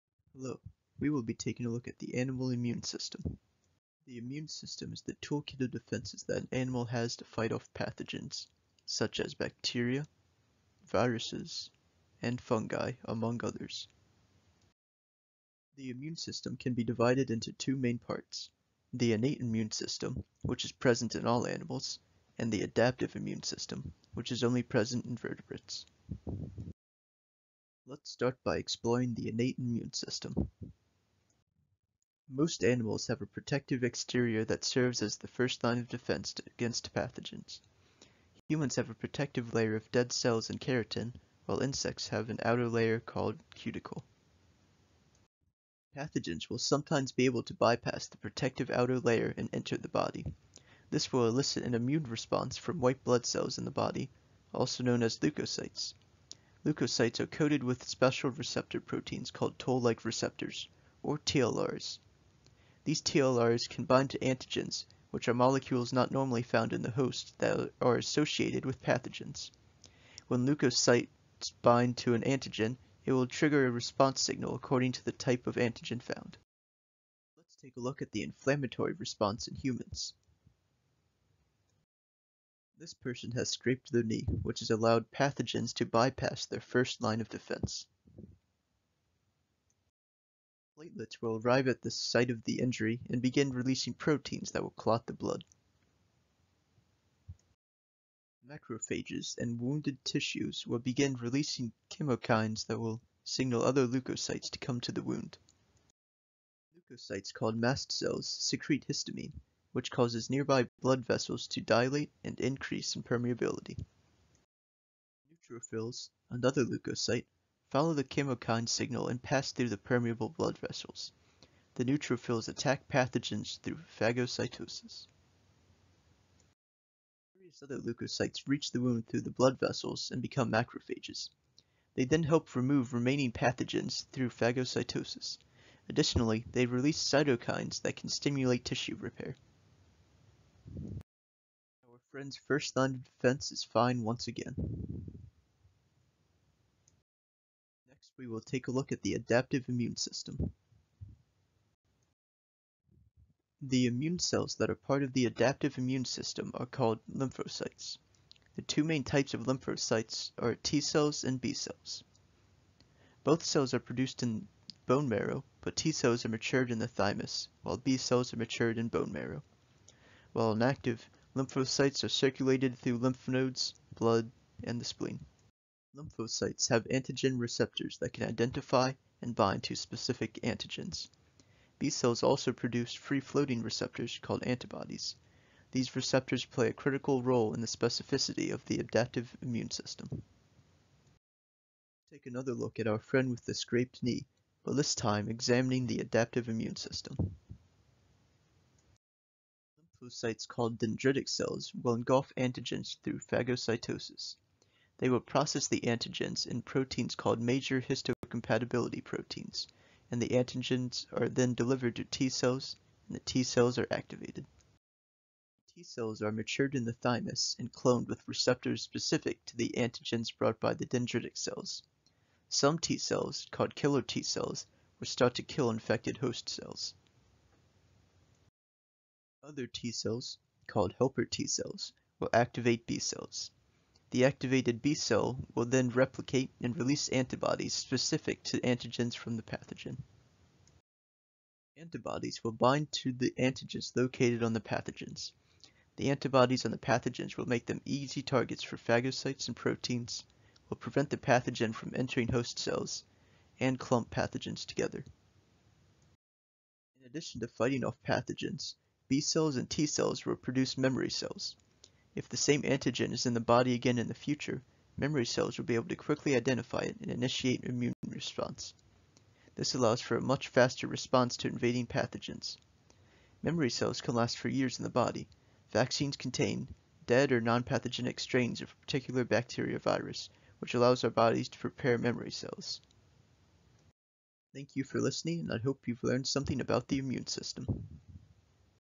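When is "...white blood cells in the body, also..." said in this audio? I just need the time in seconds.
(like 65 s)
52 s.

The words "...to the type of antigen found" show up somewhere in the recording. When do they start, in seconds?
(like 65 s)
74 s.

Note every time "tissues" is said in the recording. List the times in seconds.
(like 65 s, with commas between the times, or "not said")
100 s, 138 s.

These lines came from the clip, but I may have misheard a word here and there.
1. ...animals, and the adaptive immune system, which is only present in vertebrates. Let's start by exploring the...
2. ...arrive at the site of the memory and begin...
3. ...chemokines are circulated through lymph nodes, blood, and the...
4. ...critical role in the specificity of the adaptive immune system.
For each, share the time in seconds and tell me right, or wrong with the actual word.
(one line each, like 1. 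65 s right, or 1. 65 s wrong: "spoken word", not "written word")
1. 21 s right
2. 91 s wrong: "injury", not "memory"
3. 171 s wrong: "lymphocytes", not "chemokines"
4. 186 s right.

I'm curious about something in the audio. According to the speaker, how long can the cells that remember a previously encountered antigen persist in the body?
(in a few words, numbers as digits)
years.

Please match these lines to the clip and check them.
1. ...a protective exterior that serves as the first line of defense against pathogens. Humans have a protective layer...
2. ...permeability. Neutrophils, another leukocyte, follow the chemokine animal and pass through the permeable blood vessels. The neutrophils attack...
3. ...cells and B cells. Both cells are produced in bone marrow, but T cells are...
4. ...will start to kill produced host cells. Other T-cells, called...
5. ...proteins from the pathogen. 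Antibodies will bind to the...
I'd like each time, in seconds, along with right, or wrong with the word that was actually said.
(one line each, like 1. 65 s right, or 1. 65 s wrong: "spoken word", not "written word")
1. 33 s right
2. 113 s wrong: "signal", not "animal"
3. 160 s right
4. 224 s wrong: "infected", not "produced"
5. 238 s wrong: "antigens", not "proteins".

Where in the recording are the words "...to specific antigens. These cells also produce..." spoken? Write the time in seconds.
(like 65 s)
179 s.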